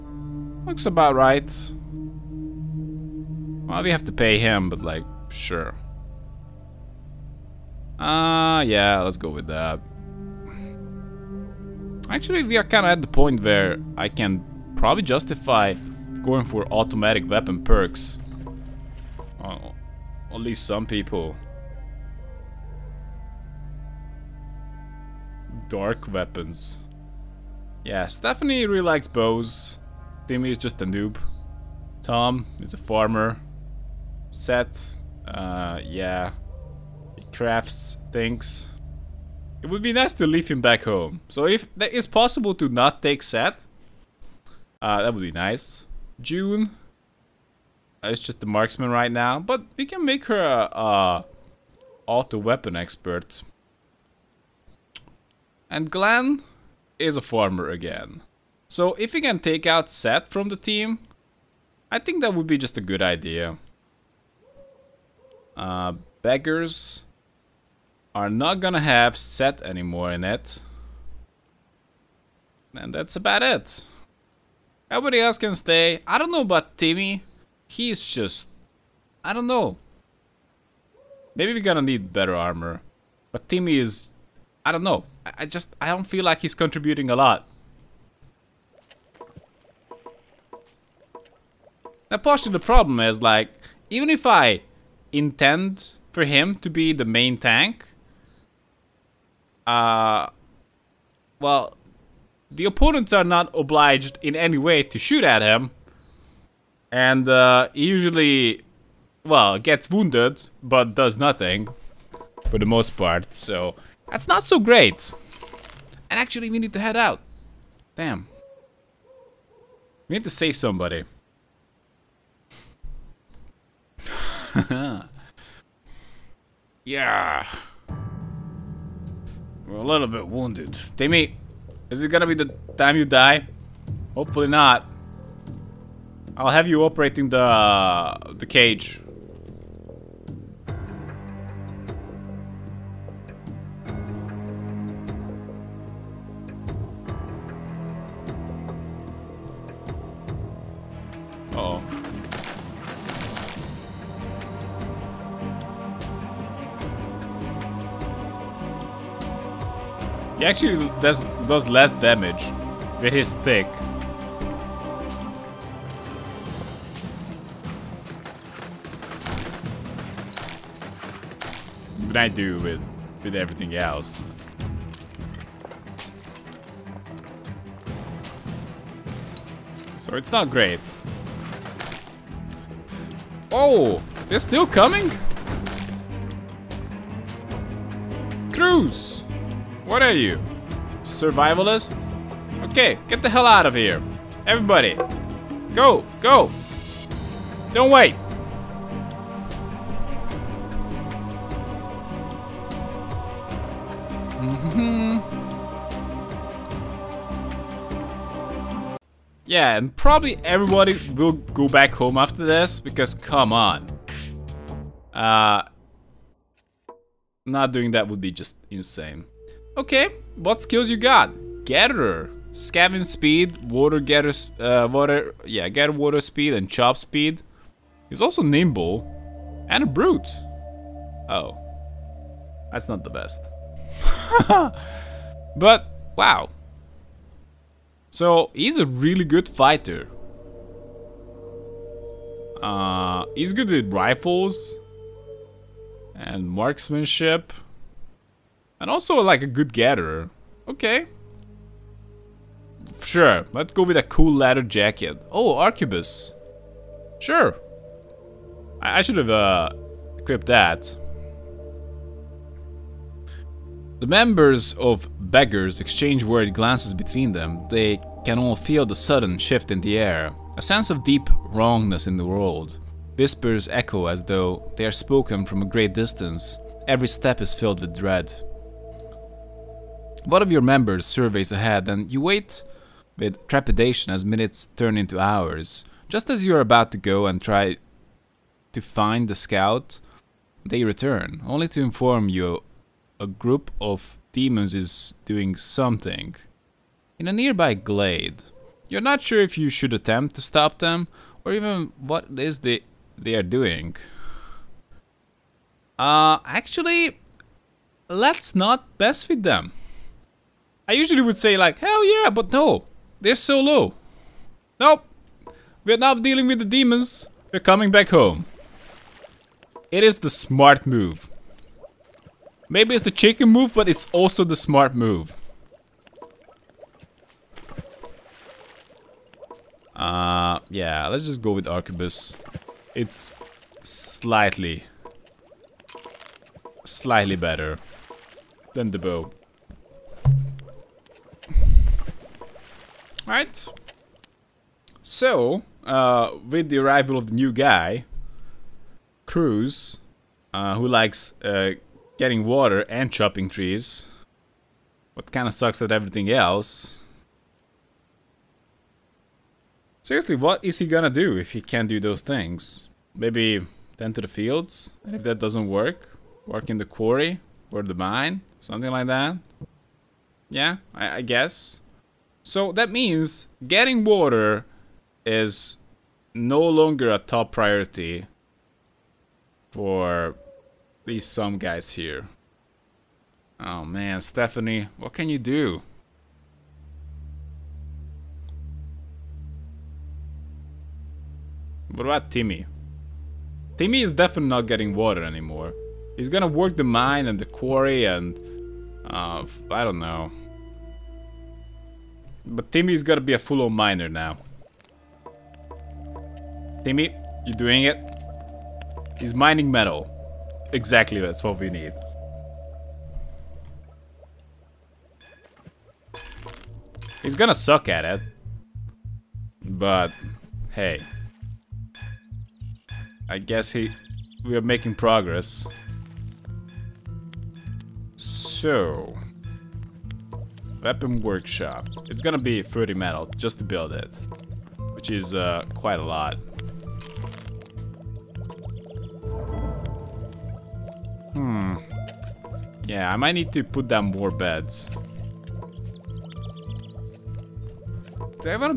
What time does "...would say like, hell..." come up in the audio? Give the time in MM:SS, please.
05:11.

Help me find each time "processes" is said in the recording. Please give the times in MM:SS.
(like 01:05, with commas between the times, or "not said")
not said.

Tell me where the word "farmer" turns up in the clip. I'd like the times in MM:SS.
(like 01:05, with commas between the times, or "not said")
00:32, 00:57.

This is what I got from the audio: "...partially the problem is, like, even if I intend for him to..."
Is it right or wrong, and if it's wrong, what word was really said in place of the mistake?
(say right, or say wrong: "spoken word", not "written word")
right.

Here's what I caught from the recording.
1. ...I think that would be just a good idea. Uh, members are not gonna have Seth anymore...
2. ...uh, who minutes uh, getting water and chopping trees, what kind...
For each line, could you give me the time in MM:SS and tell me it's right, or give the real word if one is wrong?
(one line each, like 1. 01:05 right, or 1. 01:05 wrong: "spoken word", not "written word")
1. 01:01 wrong: "beggars", not "members"
2. 05:50 wrong: "likes", not "minutes".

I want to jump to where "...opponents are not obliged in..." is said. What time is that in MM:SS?
01:42.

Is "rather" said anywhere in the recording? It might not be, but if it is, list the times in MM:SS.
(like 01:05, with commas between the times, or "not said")
not said.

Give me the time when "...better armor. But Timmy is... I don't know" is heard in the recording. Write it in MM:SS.
01:22.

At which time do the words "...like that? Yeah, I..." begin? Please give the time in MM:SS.
06:08.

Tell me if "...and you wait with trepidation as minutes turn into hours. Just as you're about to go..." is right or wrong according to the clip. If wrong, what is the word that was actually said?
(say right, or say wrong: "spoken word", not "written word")
right.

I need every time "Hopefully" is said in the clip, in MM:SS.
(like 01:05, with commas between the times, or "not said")
02:14.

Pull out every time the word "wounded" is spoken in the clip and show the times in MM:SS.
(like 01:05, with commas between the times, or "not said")
01:49, 02:10.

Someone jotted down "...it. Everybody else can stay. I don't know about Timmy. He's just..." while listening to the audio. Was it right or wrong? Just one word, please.
right.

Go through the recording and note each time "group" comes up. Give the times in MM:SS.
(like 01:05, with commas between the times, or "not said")
04:53.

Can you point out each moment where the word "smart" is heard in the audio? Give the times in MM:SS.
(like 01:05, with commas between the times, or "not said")
05:20, 05:24.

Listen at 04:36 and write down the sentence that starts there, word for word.
Every step is filled with dread.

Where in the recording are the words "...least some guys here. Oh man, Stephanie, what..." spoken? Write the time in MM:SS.
06:21.